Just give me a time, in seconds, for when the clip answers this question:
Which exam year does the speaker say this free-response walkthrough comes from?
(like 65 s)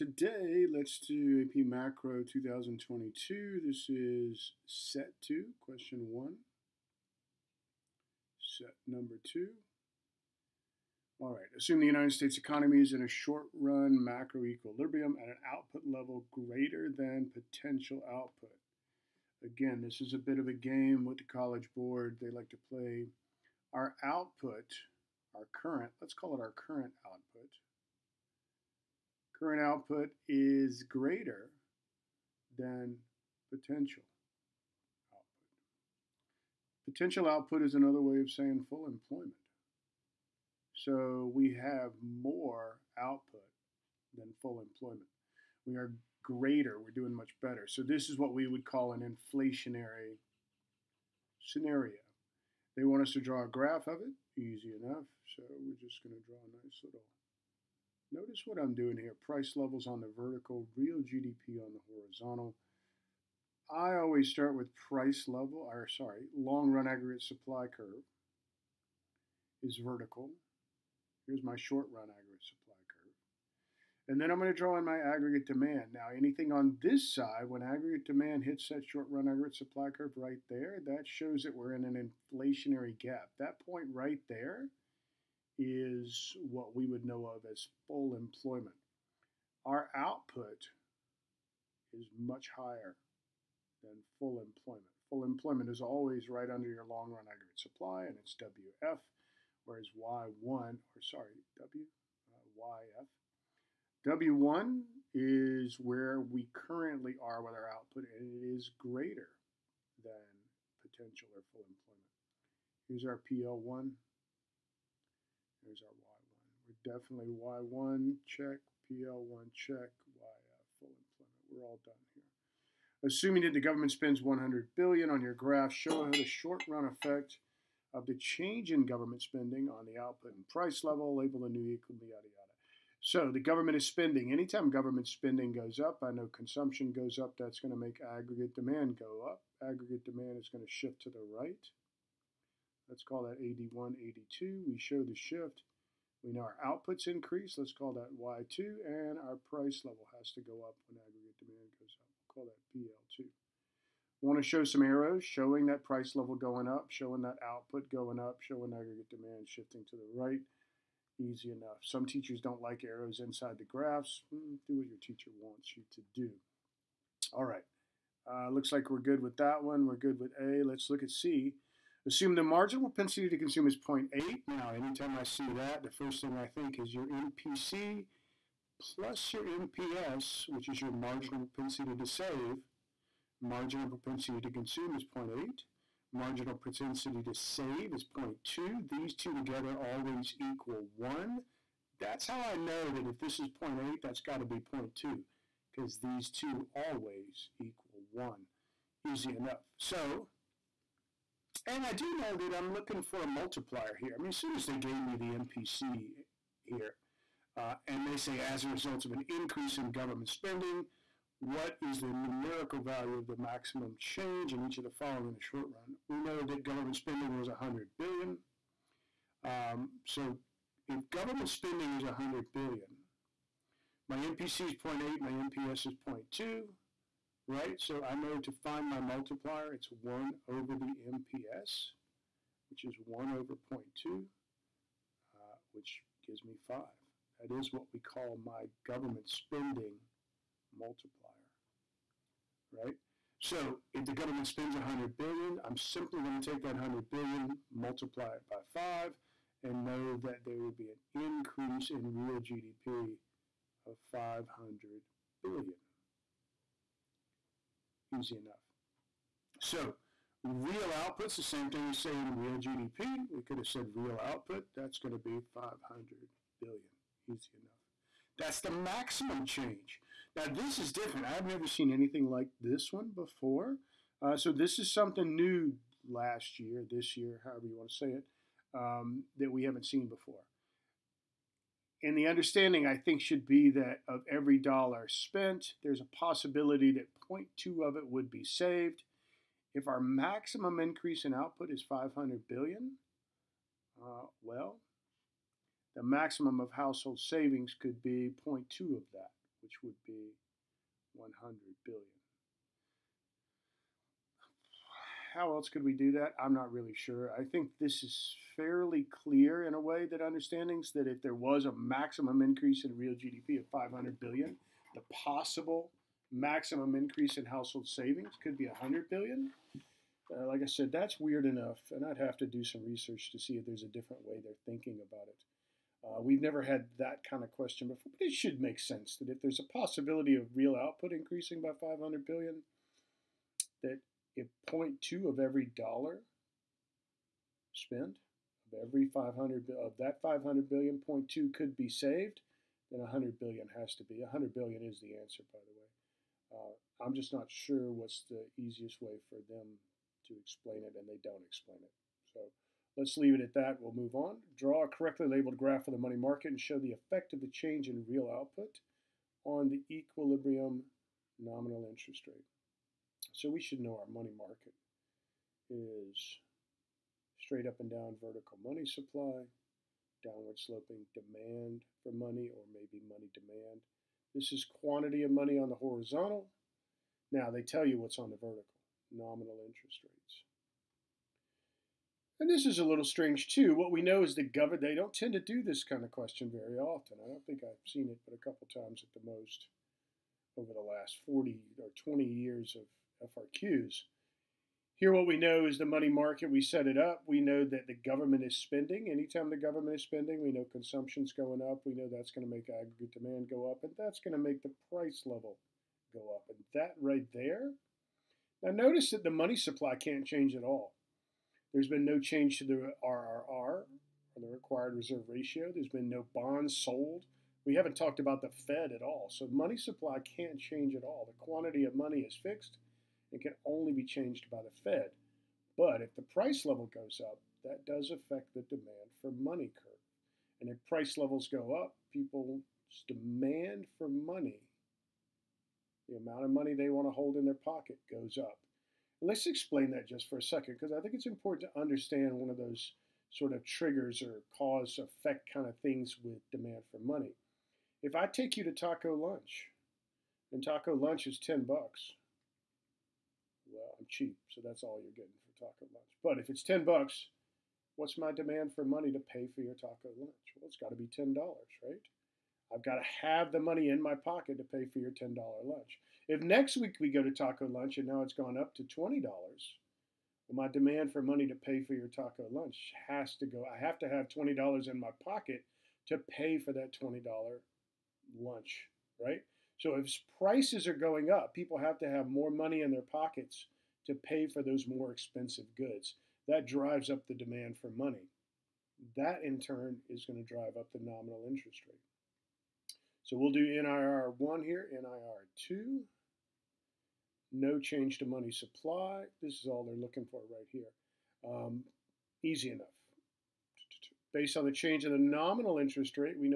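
2 s.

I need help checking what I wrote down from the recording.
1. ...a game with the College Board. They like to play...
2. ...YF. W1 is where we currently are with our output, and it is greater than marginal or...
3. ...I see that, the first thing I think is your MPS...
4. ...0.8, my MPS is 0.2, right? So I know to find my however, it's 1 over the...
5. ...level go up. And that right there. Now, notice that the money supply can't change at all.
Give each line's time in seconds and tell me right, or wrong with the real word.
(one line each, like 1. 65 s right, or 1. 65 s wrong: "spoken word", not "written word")
1. 20 s right
2. 102 s wrong: "potential", not "marginal"
3. 175 s wrong: "MPC", not "MPS"
4. 224 s wrong: "multiplier", not "however"
5. 405 s right.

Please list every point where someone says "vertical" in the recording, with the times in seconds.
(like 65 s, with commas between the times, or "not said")
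60 s, 69 s, 368 s, 378 s.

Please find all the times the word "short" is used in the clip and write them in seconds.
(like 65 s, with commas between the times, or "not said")
13 s, 71 s, 78 s, 126 s, 215 s.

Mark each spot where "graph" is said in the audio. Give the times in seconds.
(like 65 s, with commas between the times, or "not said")
53 s, 125 s, 163 s, 355 s.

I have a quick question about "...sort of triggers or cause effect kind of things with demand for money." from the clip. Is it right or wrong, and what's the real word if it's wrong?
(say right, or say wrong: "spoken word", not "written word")
right.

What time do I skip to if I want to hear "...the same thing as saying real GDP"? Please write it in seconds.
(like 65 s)
261 s.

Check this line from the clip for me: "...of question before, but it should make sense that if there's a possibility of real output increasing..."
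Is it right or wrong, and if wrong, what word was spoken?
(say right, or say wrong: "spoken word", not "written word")
right.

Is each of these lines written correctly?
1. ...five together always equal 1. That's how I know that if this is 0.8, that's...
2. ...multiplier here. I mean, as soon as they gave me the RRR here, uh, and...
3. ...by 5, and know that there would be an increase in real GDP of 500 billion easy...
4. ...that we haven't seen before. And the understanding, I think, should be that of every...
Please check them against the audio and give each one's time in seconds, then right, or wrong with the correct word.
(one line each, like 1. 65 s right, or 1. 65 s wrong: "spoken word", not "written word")
1. 189 s wrong: "two", not "five"
2. 203 s wrong: "MPC", not "RRR"
3. 248 s right
4. 279 s right.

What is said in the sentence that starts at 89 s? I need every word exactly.
Our output is much higher than full employment.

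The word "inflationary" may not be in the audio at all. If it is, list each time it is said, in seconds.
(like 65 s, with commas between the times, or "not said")
49 s, 82 s.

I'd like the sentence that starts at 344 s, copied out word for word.
100 billion is the answer, by the way.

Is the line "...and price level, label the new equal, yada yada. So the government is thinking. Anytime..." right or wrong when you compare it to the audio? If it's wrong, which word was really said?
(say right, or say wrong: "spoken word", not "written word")
wrong: "spending", not "thinking".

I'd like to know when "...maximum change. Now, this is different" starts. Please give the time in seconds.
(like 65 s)
268 s.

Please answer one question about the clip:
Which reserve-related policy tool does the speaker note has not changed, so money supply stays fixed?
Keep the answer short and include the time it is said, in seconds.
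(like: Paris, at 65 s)
Required reserve ratio, at 414 s.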